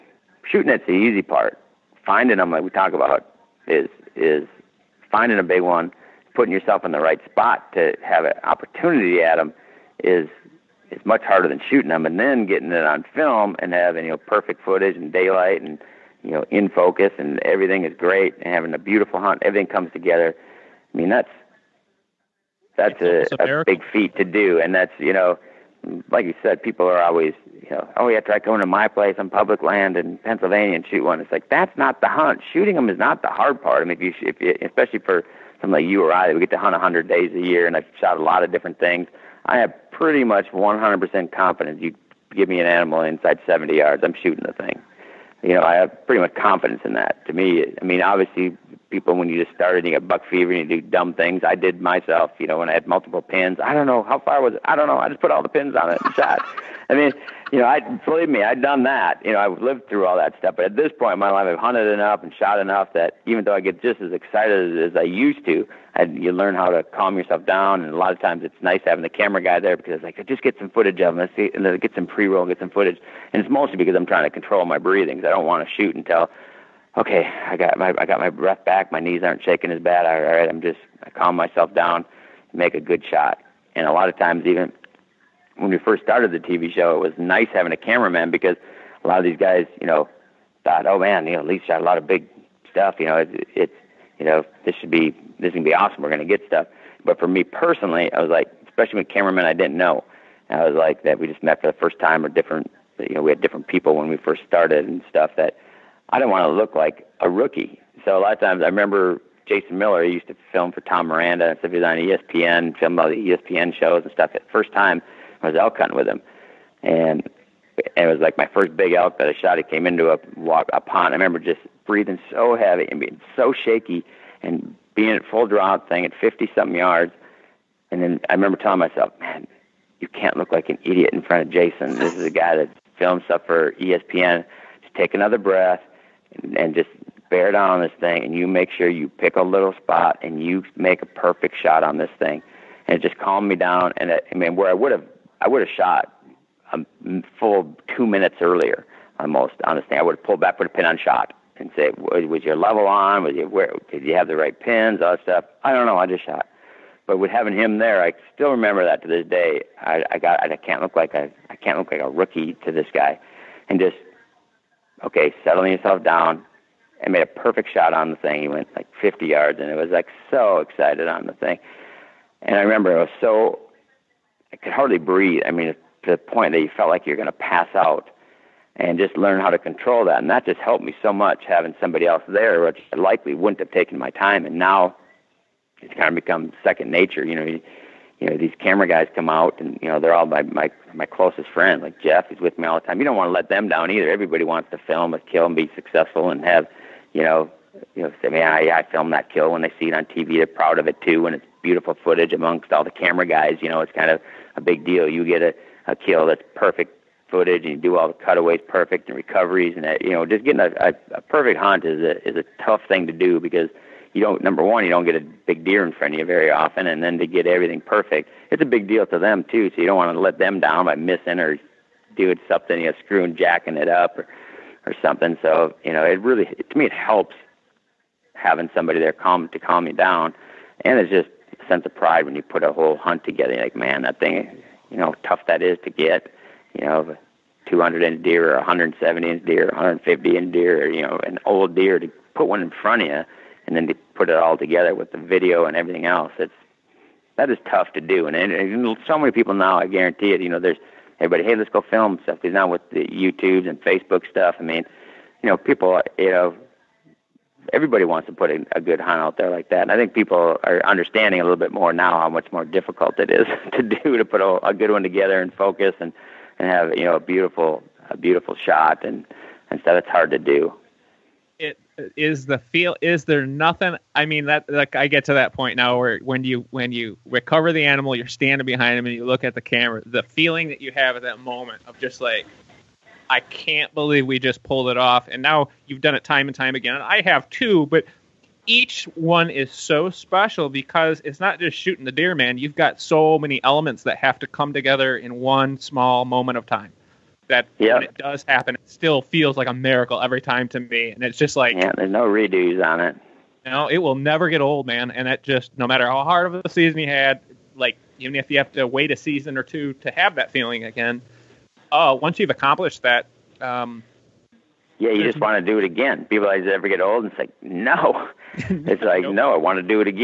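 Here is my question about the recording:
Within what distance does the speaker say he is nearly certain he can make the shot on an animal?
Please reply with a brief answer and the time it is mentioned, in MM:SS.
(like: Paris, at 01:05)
70 yards, at 00:43.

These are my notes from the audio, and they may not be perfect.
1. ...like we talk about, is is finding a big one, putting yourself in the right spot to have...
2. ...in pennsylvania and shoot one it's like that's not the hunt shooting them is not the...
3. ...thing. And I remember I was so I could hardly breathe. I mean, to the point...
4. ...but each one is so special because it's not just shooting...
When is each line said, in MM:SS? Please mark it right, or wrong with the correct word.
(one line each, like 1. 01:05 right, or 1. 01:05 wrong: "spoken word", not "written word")
1. 00:02 right
2. 00:29 right
3. 02:51 right
4. 04:47 right.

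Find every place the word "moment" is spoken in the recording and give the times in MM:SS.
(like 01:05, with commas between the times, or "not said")
04:41, 04:56.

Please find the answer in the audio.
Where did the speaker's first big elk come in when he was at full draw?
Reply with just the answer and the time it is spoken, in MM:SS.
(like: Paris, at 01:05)
A pond, at 02:00.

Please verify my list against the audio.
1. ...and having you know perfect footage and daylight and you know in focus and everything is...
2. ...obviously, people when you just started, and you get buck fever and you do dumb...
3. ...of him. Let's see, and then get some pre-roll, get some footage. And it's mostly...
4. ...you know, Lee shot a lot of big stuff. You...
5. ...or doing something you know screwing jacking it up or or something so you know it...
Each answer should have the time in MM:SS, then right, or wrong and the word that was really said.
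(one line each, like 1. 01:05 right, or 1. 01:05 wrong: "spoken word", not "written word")
1. 00:13 right
2. 00:48 right
3. 01:11 right
4. 01:31 right
5. 03:41 right.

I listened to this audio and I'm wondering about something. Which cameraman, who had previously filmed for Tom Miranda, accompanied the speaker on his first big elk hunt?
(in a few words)
Jason Miller.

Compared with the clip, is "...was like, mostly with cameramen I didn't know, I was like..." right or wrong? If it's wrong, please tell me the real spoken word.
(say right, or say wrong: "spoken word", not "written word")
wrong: "especially", not "mostly".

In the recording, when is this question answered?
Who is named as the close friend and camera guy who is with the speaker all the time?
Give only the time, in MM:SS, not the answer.
03:12.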